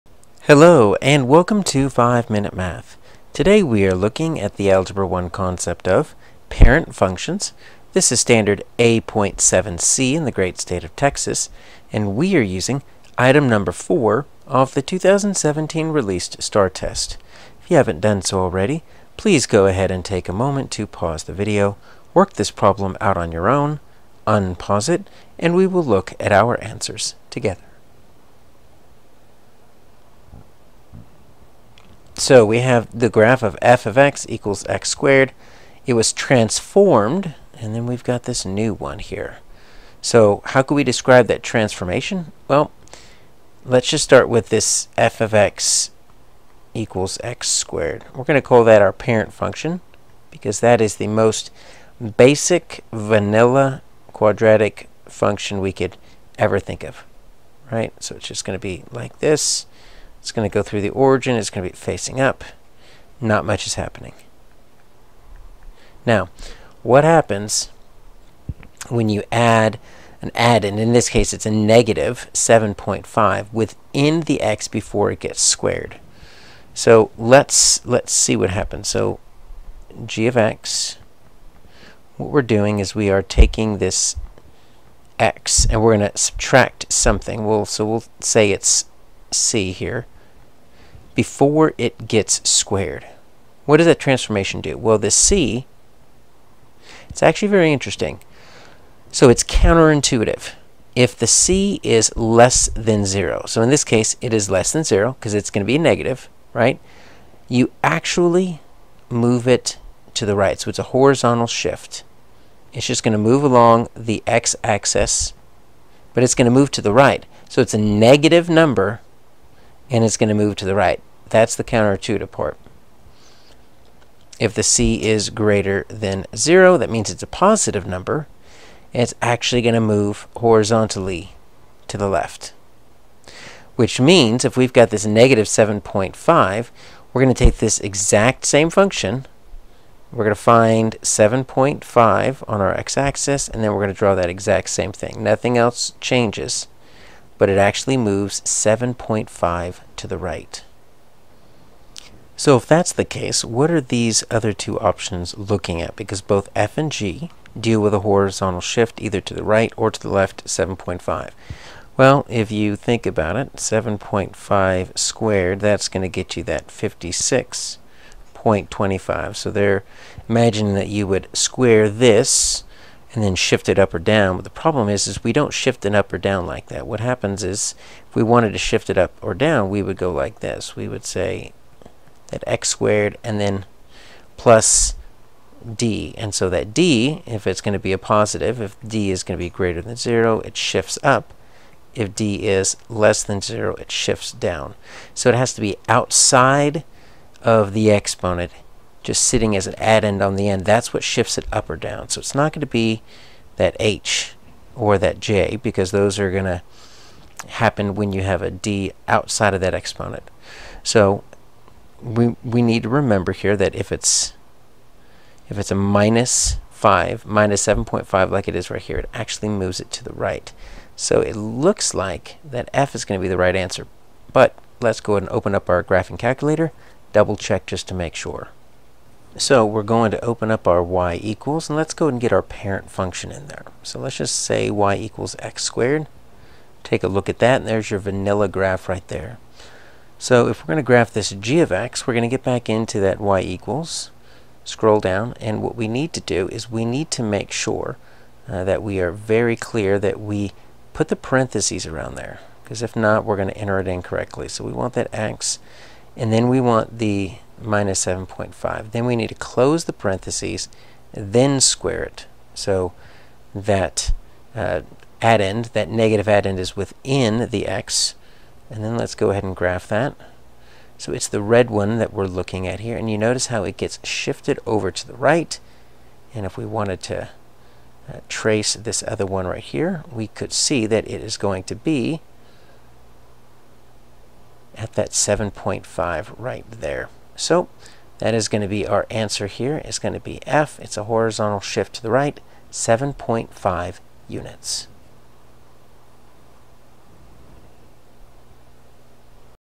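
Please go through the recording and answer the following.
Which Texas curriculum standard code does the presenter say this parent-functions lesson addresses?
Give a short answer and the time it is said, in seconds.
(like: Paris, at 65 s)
A.7c, at 8 s.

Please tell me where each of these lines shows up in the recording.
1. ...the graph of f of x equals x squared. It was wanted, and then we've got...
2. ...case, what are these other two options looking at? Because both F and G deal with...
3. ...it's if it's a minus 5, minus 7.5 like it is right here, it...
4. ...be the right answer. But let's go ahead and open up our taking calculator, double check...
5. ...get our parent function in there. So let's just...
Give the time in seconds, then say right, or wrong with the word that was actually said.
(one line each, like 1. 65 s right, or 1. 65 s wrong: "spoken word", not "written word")
1. 32 s wrong: "transformed", not "wanted"
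2. 153 s right
3. 213 s right
4. 223 s wrong: "graphing", not "taking"
5. 232 s right.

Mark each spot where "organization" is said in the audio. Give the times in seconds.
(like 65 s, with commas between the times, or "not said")
not said.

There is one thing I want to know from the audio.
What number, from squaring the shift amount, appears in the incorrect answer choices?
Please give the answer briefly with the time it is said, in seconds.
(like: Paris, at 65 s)
56.25, at 166 s.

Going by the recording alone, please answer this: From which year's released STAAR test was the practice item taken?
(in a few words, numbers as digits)
2017.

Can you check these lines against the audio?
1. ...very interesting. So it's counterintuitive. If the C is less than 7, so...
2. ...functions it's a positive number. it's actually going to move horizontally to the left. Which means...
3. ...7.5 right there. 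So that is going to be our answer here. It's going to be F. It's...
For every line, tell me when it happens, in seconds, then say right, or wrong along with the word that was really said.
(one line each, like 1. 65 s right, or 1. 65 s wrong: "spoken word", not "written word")
1. 97 s wrong: "0", not "7"
2. 126 s wrong: "means", not "functions"
3. 285 s right.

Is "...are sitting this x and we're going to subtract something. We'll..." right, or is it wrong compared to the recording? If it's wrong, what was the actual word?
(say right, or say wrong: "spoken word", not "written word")
wrong: "taking", not "sitting".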